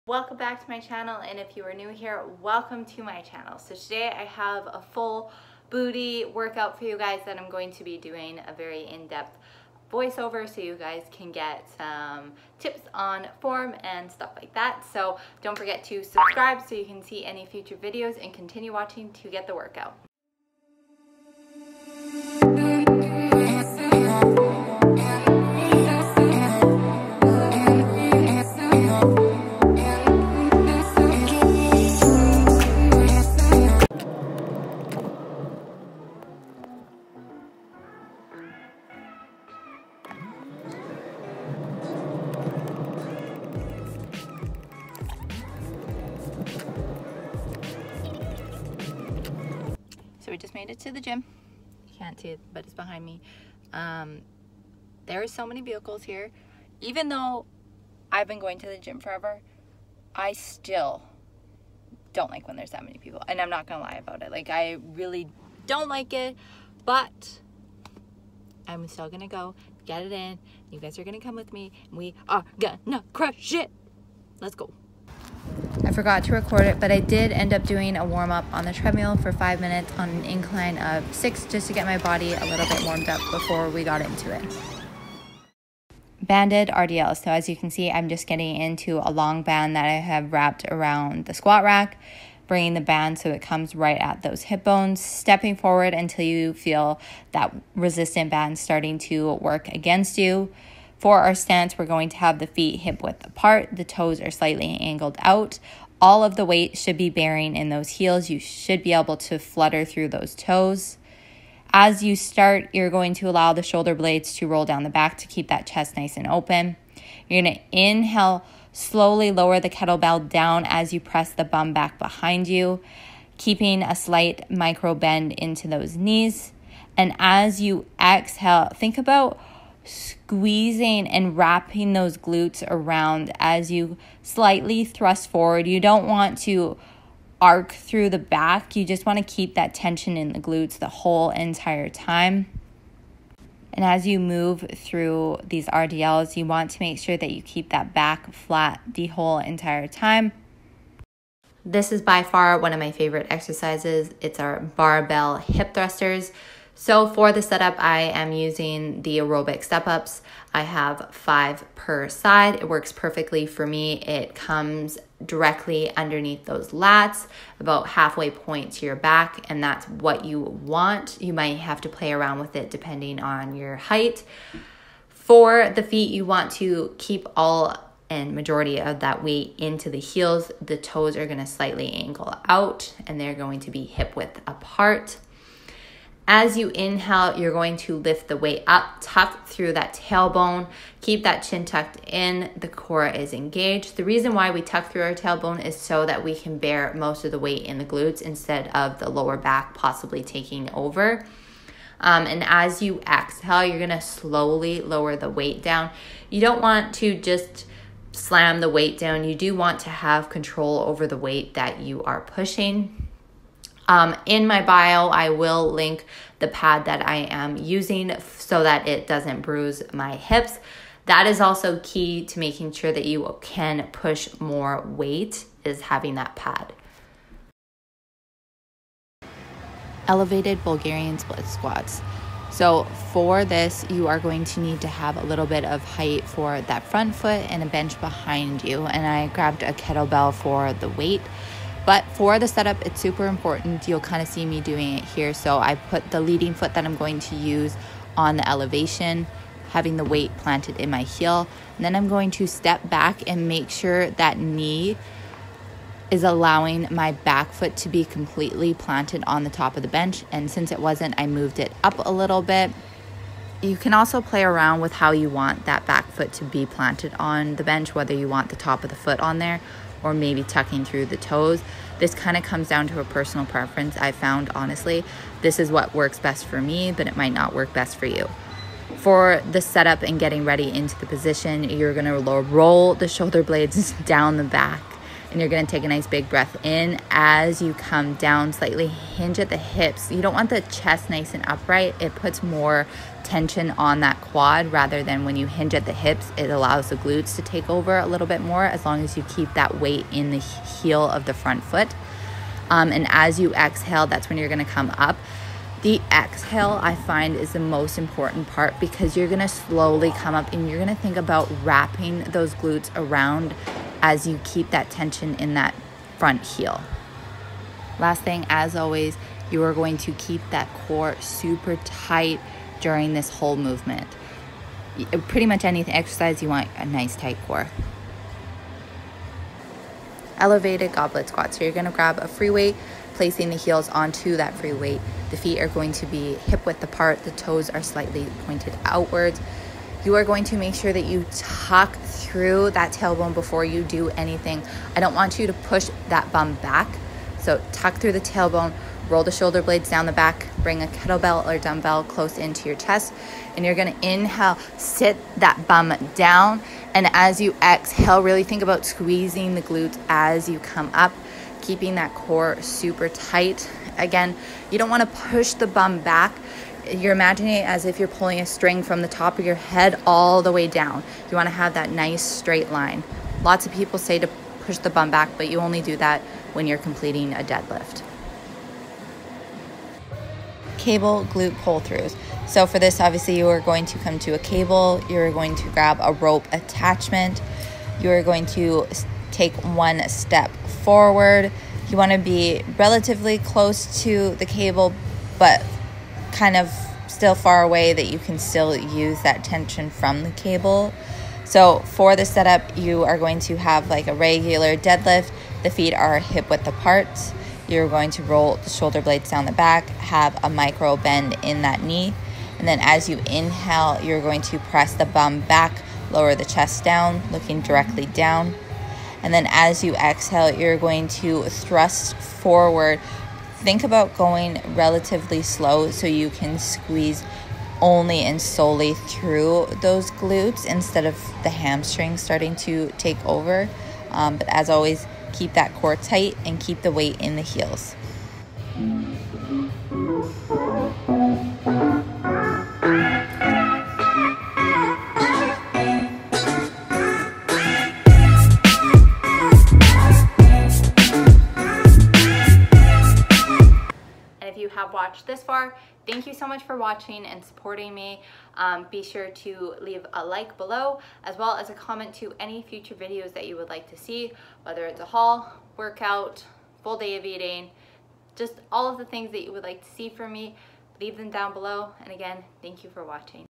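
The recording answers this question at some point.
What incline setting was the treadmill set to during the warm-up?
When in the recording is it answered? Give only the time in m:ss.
1:20.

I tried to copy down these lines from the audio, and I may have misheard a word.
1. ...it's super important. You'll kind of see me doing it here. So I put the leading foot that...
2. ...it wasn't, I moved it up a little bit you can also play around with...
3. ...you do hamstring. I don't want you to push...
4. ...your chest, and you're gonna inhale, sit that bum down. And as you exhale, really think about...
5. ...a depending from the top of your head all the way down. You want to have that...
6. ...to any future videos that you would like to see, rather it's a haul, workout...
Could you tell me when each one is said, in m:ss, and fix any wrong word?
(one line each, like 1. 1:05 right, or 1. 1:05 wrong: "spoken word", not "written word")
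1. 4:02 right
2. 4:20 right
3. 5:43 wrong: "anything", not "hamstring"
4. 5:52 right
5. 6:08 wrong: "string", not "depending"
6. 7:42 wrong: "whether", not "rather".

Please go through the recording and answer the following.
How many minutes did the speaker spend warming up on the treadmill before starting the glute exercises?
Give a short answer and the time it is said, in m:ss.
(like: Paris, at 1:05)
5, at 1:19.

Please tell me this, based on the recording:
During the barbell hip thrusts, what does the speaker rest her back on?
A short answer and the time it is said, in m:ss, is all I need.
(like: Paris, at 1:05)
aerobic step ups, at 2:39.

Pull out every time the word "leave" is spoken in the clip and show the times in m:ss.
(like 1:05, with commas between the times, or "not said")
7:39, 7:51.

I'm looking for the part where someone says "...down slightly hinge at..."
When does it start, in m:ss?
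4:48.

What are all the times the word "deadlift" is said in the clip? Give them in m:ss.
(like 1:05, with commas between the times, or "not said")
6:17, 6:44.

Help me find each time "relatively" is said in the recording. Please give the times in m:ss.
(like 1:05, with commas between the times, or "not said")
6:32, 7:04.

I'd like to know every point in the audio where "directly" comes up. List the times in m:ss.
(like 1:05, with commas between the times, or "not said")
2:45, 6:57.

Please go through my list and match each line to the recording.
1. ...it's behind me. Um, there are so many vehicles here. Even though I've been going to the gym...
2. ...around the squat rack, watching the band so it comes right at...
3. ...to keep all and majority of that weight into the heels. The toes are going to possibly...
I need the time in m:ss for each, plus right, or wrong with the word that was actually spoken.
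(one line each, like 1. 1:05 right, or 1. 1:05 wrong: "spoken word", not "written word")
1. 0:52 right
2. 1:30 wrong: "bringing", not "watching"
3. 2:56 wrong: "slightly", not "possibly".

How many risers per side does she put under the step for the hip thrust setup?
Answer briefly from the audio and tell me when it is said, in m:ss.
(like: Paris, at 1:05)
5, at 2:41.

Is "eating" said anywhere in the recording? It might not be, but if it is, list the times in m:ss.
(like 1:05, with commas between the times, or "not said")
7:47.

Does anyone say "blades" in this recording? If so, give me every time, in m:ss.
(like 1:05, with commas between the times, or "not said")
1:53, 4:43, 5:49, 6:49.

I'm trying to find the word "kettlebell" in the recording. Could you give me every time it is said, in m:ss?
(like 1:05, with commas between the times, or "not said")
1:59, 3:59, 5:50.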